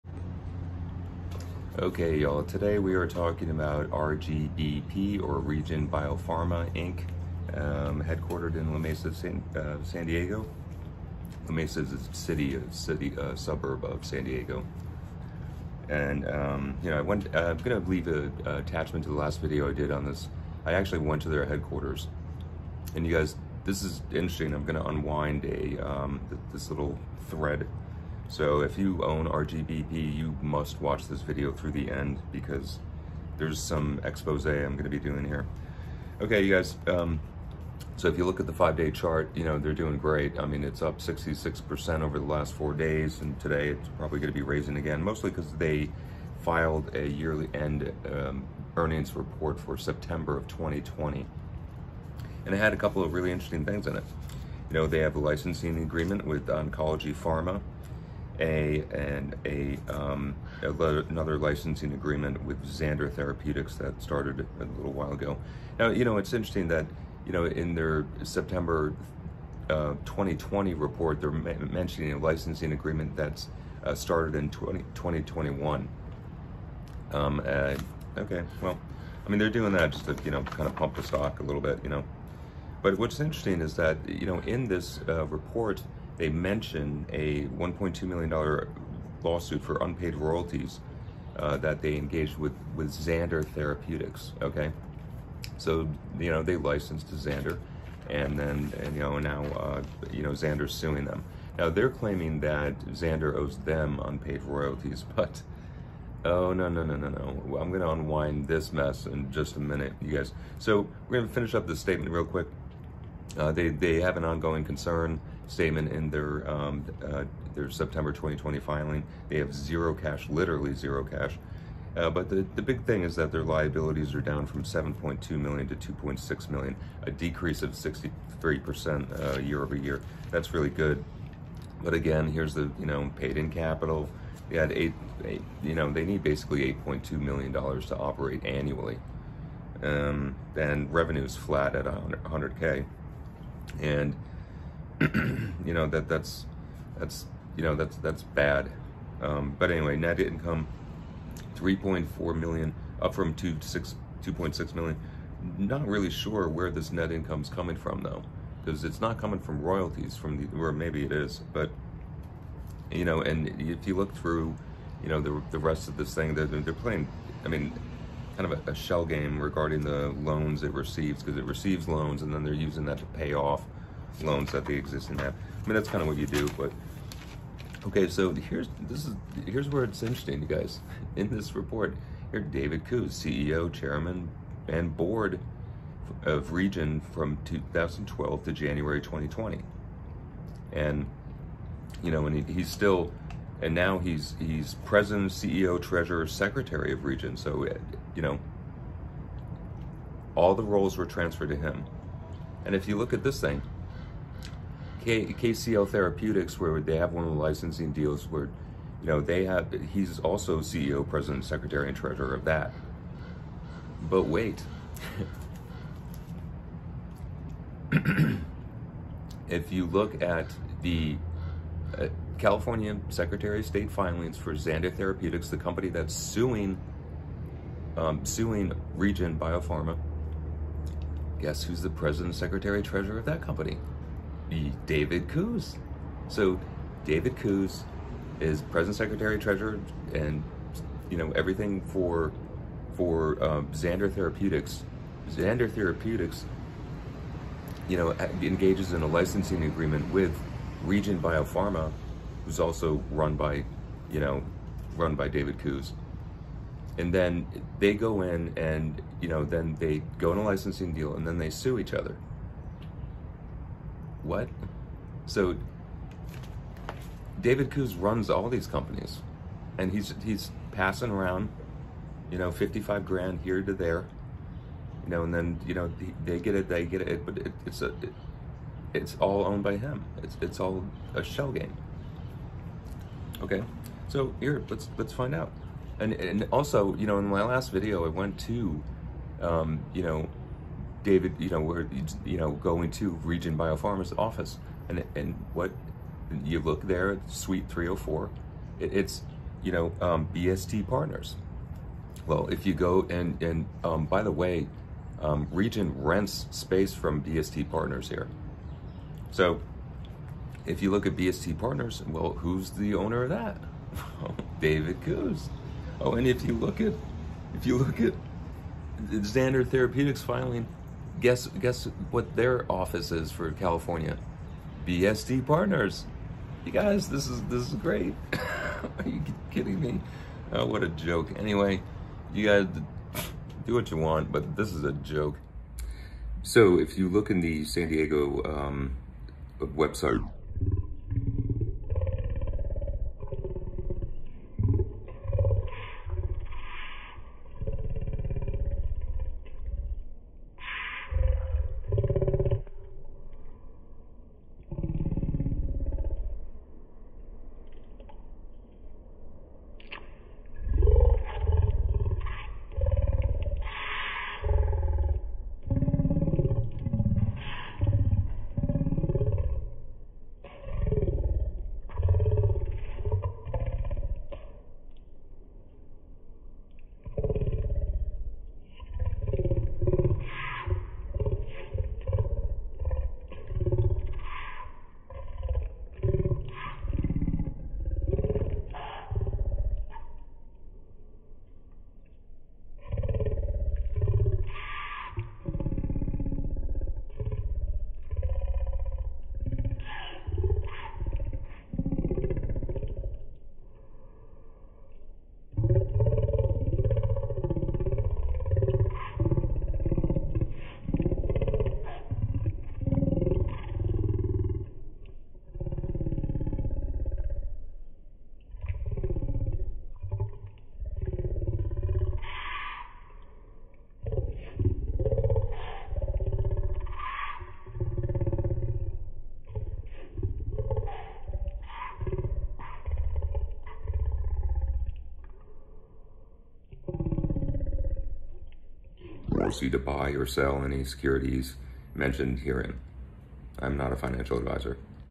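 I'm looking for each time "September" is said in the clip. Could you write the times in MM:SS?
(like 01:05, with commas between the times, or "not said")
00:49, 01:08, 01:57.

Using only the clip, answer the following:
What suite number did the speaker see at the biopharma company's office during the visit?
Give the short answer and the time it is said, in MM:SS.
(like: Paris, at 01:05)
304, at 04:57.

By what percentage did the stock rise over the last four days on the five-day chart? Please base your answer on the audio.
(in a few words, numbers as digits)
66%.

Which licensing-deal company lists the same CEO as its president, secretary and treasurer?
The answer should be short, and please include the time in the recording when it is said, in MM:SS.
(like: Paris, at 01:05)
KCL Therapeutics, at 03:25.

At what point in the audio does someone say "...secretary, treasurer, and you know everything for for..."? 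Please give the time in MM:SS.
03:58.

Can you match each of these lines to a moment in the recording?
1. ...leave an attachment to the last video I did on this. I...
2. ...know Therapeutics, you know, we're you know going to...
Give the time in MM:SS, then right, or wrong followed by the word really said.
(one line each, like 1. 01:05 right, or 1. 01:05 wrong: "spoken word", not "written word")
1. 00:17 right
2. 04:50 wrong: "David", not "Therapeutics".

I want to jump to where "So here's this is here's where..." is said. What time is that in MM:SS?
02:58.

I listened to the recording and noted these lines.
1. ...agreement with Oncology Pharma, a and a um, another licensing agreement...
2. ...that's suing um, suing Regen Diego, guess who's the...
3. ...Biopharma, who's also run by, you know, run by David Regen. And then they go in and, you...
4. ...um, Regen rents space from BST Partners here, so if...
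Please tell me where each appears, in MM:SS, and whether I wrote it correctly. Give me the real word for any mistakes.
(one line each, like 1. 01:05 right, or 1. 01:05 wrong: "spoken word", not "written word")
1. 00:55 right
2. 03:45 wrong: "Biopharma", not "Diego"
3. 04:11 wrong: "Koos", not "Regen"
4. 05:05 right.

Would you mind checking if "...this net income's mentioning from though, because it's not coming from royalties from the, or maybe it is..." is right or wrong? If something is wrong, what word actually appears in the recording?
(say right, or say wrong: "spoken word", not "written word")
wrong: "coming", not "mentioning".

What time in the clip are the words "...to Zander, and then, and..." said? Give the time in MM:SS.
01:37.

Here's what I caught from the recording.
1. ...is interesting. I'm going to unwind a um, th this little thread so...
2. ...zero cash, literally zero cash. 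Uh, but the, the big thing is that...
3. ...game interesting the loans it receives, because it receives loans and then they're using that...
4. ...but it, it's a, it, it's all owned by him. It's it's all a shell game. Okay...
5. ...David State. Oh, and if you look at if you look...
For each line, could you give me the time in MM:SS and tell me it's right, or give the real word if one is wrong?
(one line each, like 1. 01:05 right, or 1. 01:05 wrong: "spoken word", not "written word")
1. 00:23 right
2. 01:59 right
3. 02:49 wrong: "regarding", not "interesting"
4. 04:37 right
5. 05:14 wrong: "Koos", not "State".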